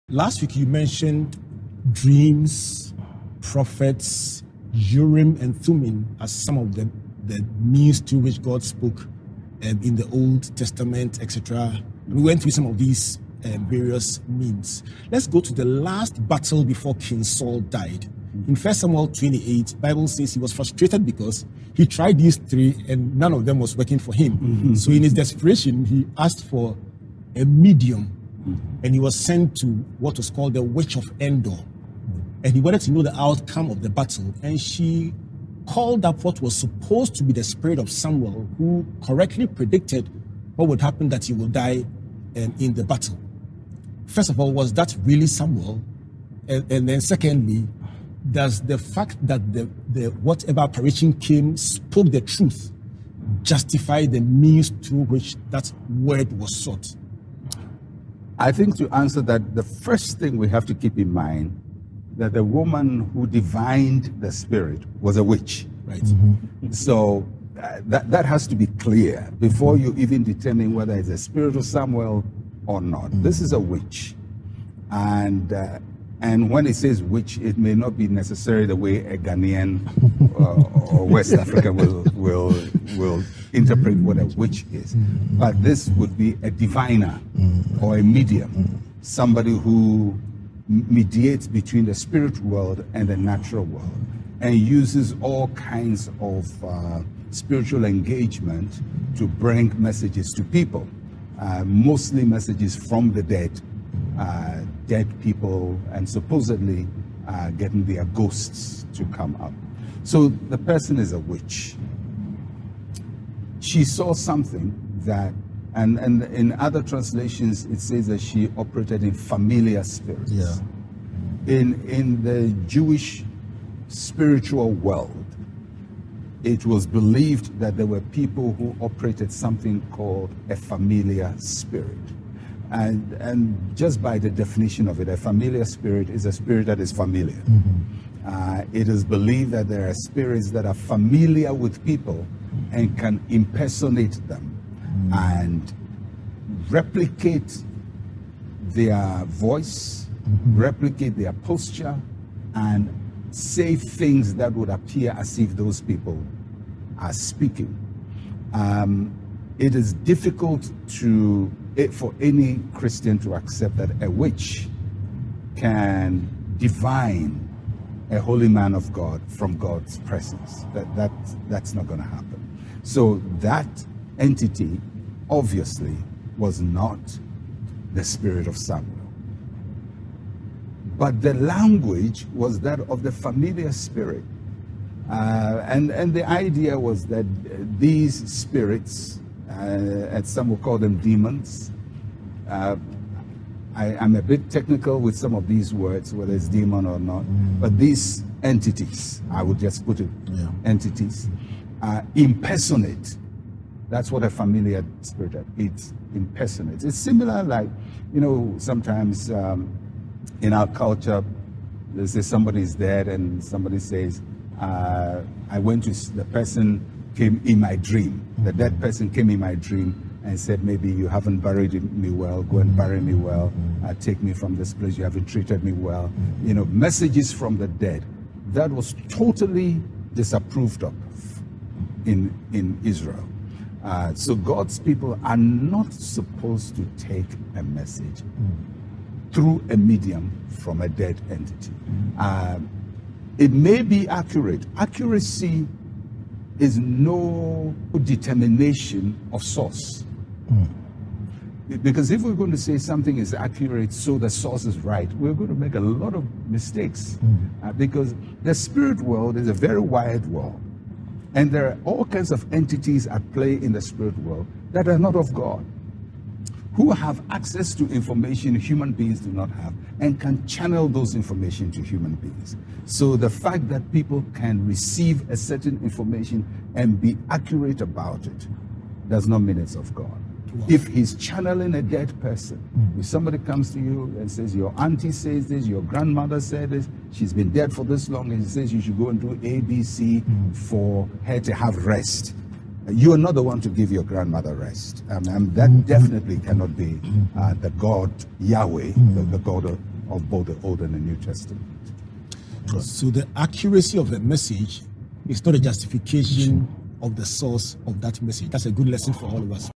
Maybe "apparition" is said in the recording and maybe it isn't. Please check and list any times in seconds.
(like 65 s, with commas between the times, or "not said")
50 s.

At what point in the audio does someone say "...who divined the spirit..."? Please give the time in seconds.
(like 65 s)
63 s.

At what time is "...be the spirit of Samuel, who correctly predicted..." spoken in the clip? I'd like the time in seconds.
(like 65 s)
37 s.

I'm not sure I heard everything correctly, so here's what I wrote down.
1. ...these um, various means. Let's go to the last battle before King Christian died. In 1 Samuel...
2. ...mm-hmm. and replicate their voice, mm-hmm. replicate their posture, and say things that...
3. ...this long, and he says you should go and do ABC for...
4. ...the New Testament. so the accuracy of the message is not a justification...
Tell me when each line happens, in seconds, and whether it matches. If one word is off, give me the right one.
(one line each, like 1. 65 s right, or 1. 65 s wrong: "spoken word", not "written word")
1. 12 s wrong: "Saul", not "Christian"
2. 144 s right
3. 287 s right
4. 300 s right.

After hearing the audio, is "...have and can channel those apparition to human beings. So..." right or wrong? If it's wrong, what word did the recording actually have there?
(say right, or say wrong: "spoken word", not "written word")
wrong: "information", not "apparition".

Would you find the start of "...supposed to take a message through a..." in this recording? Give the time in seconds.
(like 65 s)
235 s.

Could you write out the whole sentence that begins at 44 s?
First of all, was that really Samuel?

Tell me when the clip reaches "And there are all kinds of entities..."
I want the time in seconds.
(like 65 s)
261 s.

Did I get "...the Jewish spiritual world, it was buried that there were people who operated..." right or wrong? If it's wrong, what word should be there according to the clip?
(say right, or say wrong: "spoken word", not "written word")
wrong: "believed", not "buried".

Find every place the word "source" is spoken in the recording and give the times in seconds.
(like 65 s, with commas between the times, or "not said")
249 s, 254 s, 307 s.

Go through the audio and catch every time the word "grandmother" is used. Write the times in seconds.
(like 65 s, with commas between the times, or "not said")
285 s, 294 s.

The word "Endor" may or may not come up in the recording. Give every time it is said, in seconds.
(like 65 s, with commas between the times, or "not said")
31 s.